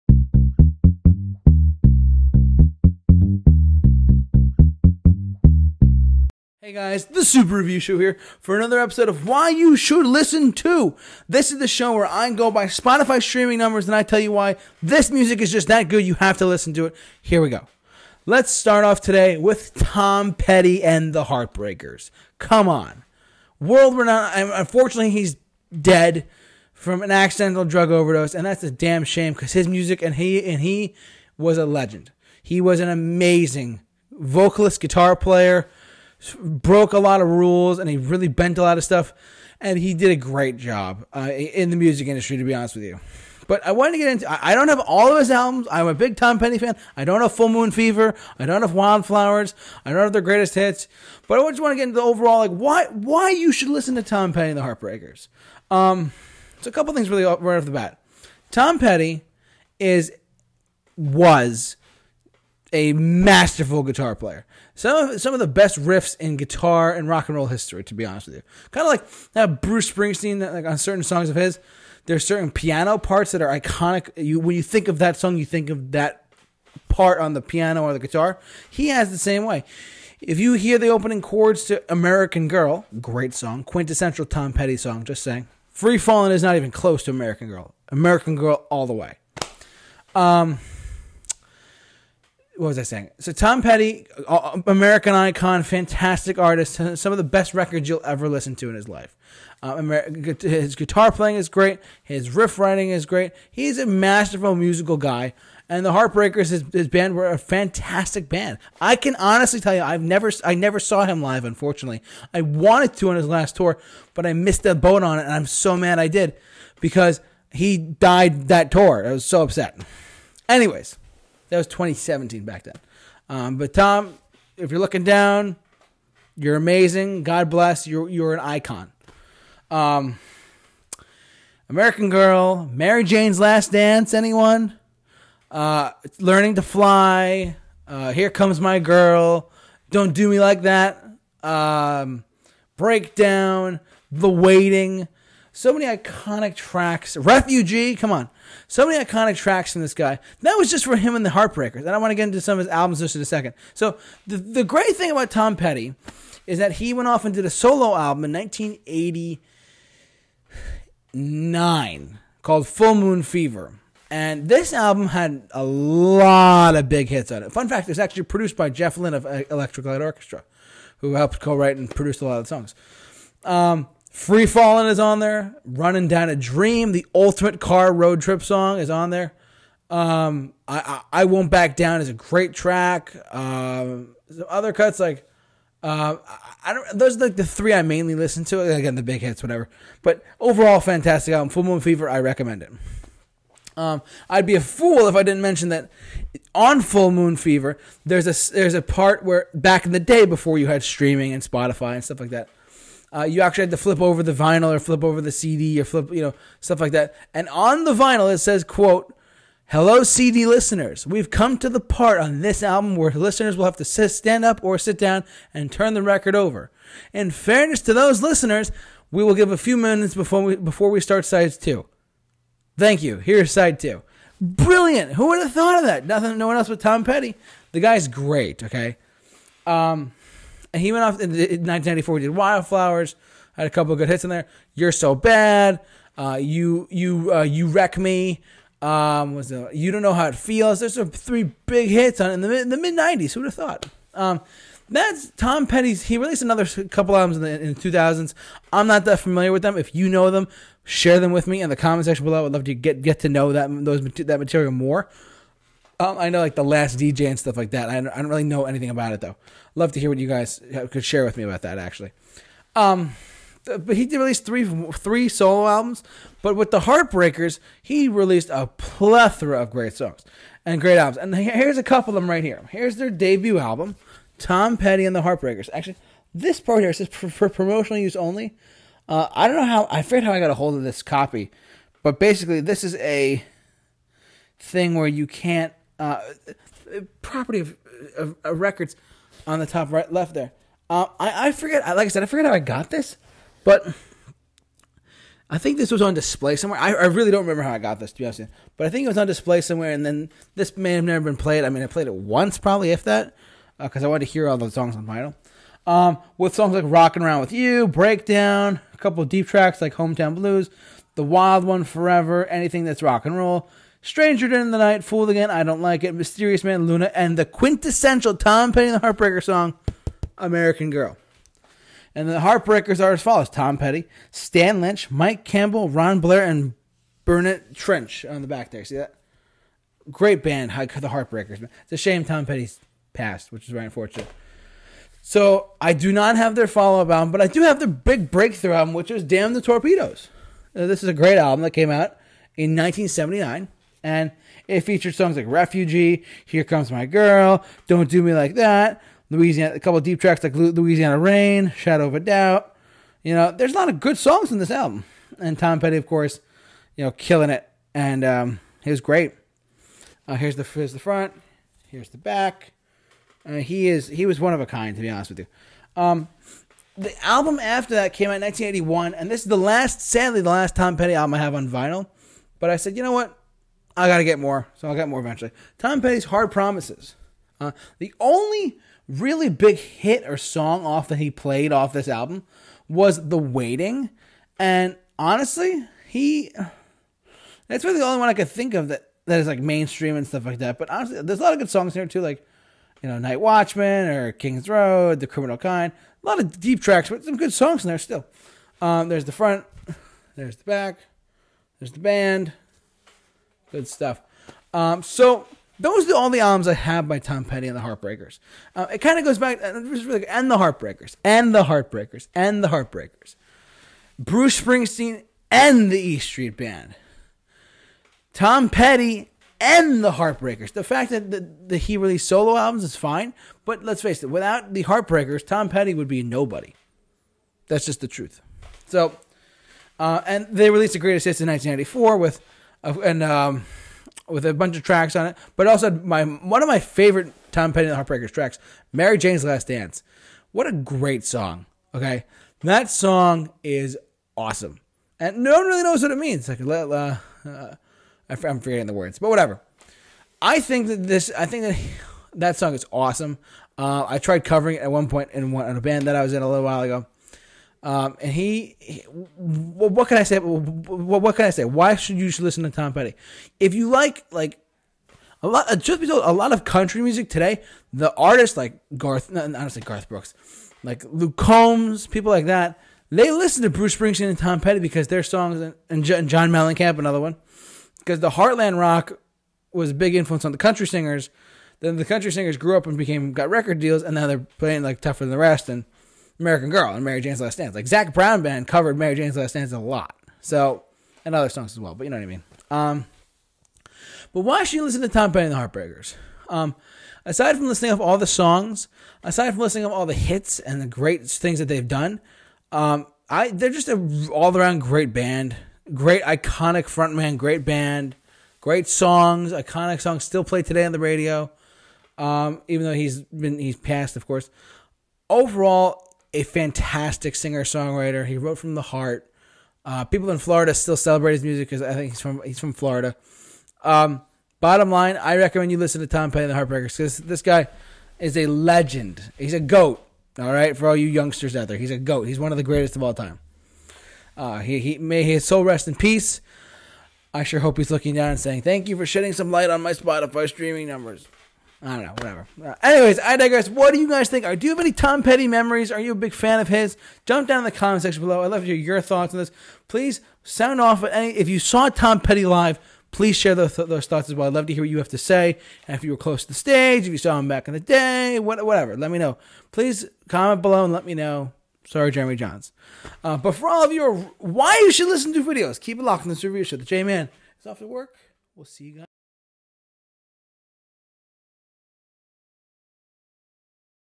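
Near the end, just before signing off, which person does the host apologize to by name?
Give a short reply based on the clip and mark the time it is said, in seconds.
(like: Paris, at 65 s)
Jeremy Johns, at 562 s.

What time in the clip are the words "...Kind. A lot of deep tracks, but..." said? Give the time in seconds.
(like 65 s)
395 s.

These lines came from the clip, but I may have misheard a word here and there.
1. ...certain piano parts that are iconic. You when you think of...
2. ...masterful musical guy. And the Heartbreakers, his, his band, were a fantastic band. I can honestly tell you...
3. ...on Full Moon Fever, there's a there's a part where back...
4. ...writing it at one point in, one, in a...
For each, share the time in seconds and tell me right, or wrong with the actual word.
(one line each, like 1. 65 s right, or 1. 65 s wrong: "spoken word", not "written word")
1. 72 s right
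2. 103 s right
3. 196 s right
4. 454 s wrong: "covering", not "writing".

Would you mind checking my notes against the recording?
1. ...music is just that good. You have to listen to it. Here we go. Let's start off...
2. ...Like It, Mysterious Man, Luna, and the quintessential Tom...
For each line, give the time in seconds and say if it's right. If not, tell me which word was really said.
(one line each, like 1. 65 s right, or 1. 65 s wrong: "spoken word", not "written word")
1. 15 s right
2. 315 s right.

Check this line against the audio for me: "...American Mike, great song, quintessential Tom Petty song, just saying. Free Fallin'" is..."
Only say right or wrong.
wrong.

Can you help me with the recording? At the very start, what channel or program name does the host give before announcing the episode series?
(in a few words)
Super Review Show.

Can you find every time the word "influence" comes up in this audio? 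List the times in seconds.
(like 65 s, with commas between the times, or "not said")
480 s.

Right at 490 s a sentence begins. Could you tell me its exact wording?
So and other songs as well, but you know what I mean.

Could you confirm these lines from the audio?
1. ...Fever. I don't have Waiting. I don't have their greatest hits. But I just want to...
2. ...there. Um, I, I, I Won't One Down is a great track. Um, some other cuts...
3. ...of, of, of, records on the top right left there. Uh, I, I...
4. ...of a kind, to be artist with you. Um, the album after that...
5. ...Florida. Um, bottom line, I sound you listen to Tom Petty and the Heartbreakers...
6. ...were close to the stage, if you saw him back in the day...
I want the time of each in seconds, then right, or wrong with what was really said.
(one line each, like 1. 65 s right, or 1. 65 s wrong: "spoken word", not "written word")
1. 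47 s wrong: "Wildflowers", not "Waiting"
2. 179 s wrong: "Back", not "One"
3. 287 s right
4. 364 s wrong: "honest", not "artist"
5. 522 s wrong: "recommend", not "sound"
6. 556 s right.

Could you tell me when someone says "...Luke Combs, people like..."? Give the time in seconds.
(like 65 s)
471 s.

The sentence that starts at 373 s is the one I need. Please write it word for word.
I got to get more, so I'll get more eventually.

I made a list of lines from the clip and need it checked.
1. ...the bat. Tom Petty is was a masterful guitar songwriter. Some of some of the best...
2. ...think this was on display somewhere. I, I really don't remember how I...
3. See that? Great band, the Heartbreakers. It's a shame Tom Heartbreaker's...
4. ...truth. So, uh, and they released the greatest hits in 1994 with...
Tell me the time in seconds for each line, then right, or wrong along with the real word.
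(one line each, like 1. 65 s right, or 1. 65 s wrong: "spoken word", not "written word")
1. 57 s wrong: "player", not "songwriter"
2. 295 s right
3. 328 s wrong: "Petty", not "Heartbreaker"
4. 428 s right.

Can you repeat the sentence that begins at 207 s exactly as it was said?
And on the vinyl, it says, quote, Hello, CD listeners.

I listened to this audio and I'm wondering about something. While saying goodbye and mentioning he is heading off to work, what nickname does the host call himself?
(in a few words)
The J Man.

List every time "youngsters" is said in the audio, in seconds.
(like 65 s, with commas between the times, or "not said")
531 s.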